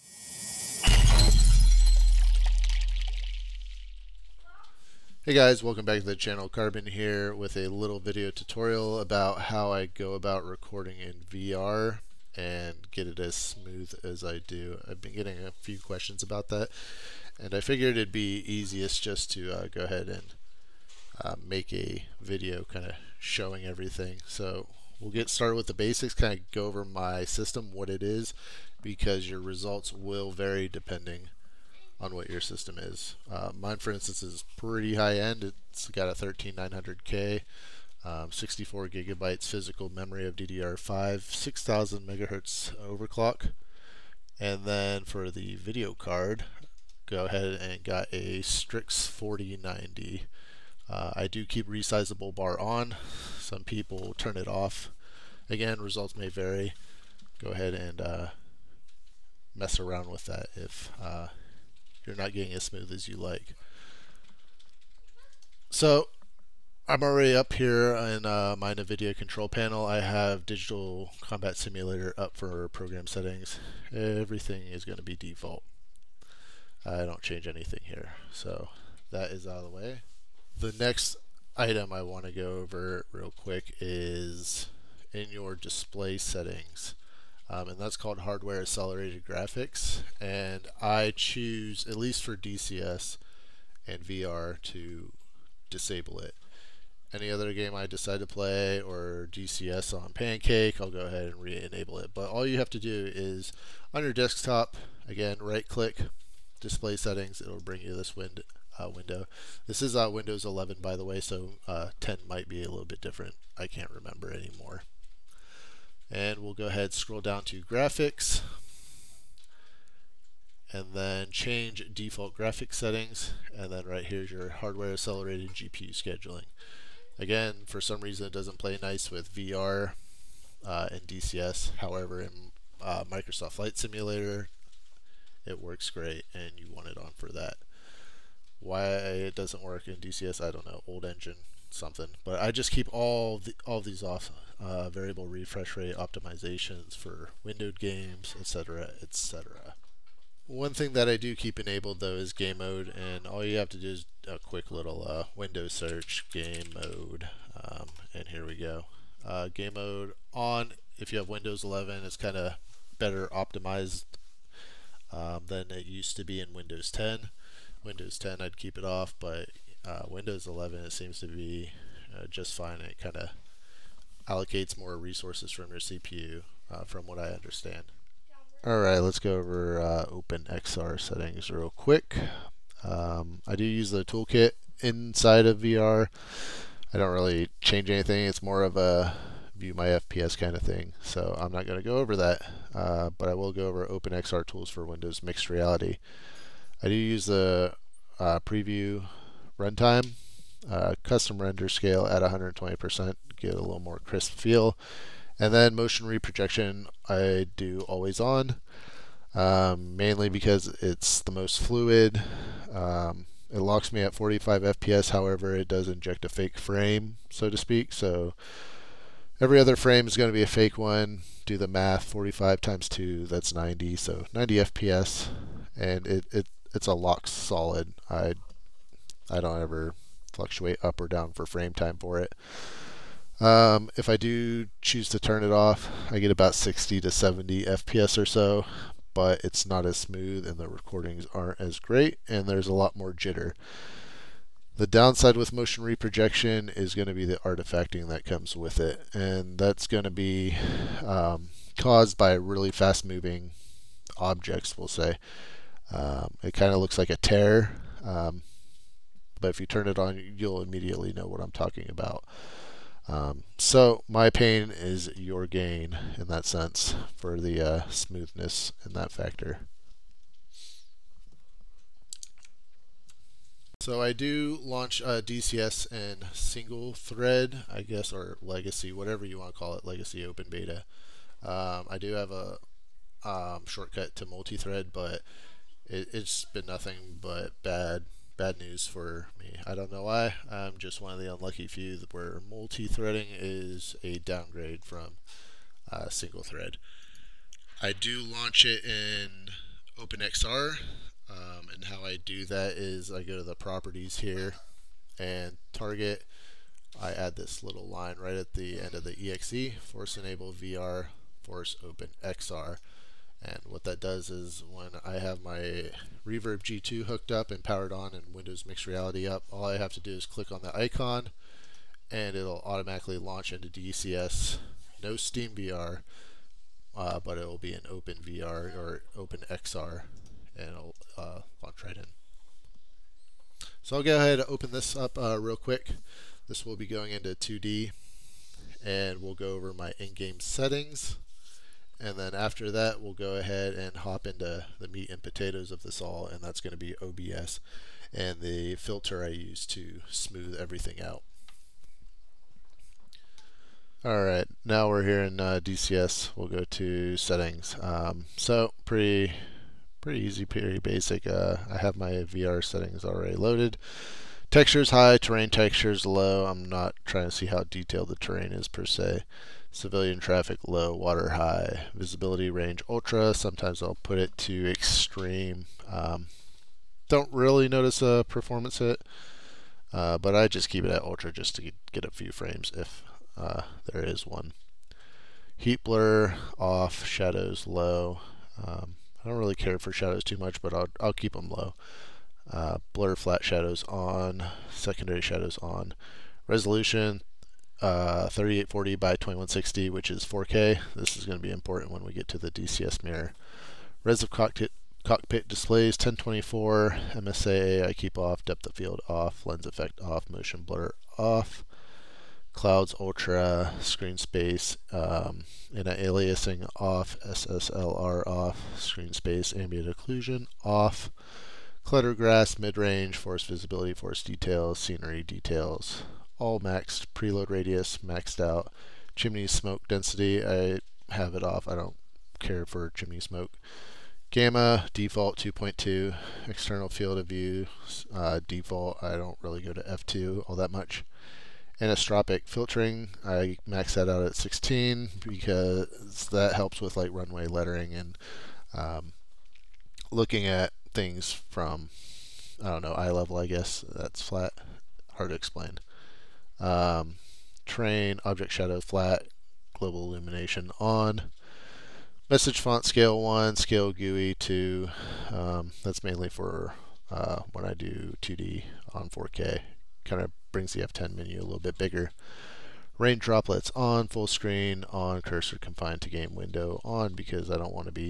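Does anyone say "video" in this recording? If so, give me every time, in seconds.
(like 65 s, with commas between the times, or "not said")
7 s, 22 s, 45 s.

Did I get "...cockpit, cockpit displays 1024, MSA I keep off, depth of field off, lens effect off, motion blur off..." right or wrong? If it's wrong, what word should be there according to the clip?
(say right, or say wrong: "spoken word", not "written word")
right.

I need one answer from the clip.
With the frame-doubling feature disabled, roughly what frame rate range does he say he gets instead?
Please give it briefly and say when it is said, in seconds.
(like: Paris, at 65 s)
60 to 70 FPS, at 236 s.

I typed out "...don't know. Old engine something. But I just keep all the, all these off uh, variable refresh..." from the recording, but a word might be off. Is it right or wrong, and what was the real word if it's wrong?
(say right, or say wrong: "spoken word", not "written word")
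right.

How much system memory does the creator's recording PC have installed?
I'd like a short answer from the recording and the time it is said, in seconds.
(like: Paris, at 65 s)
64 GB, at 38 s.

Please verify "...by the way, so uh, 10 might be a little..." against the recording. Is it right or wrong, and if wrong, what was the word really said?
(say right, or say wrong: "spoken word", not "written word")
right.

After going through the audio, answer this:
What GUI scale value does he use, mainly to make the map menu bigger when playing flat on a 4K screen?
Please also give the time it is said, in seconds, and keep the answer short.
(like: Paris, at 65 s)
2, at 463 s.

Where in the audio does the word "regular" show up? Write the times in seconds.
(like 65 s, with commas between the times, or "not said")
not said.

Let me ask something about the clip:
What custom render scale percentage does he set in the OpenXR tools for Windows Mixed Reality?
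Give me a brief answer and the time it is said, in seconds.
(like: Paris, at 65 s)
120%, at 202 s.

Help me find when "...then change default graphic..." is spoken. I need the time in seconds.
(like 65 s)
120 s.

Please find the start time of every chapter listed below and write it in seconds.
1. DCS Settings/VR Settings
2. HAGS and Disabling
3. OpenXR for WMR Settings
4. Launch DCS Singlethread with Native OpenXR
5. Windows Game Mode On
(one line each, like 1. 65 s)
1. 353 s
2. 79 s
3. 178 s
4. 279 s
5. 149 s.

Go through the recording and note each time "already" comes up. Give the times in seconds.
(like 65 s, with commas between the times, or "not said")
67 s, 363 s.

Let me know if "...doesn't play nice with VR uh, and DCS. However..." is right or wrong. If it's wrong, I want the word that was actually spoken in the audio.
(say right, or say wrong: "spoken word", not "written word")
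right.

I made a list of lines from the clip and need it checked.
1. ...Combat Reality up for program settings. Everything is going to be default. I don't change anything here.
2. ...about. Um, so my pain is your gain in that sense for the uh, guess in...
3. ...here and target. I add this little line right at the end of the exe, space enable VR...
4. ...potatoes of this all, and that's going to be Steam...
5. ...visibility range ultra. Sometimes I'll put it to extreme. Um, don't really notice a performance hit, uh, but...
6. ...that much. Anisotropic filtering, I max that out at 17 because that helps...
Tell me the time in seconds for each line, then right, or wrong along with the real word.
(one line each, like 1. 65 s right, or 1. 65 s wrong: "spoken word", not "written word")
1. 71 s wrong: "Simulator", not "Reality"
2. 261 s wrong: "smoothness", not "guess"
3. 304 s wrong: "force", not "space"
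4. 345 s wrong: "OBS", not "Steam"
5. 371 s right
6. 440 s wrong: "16", not "17".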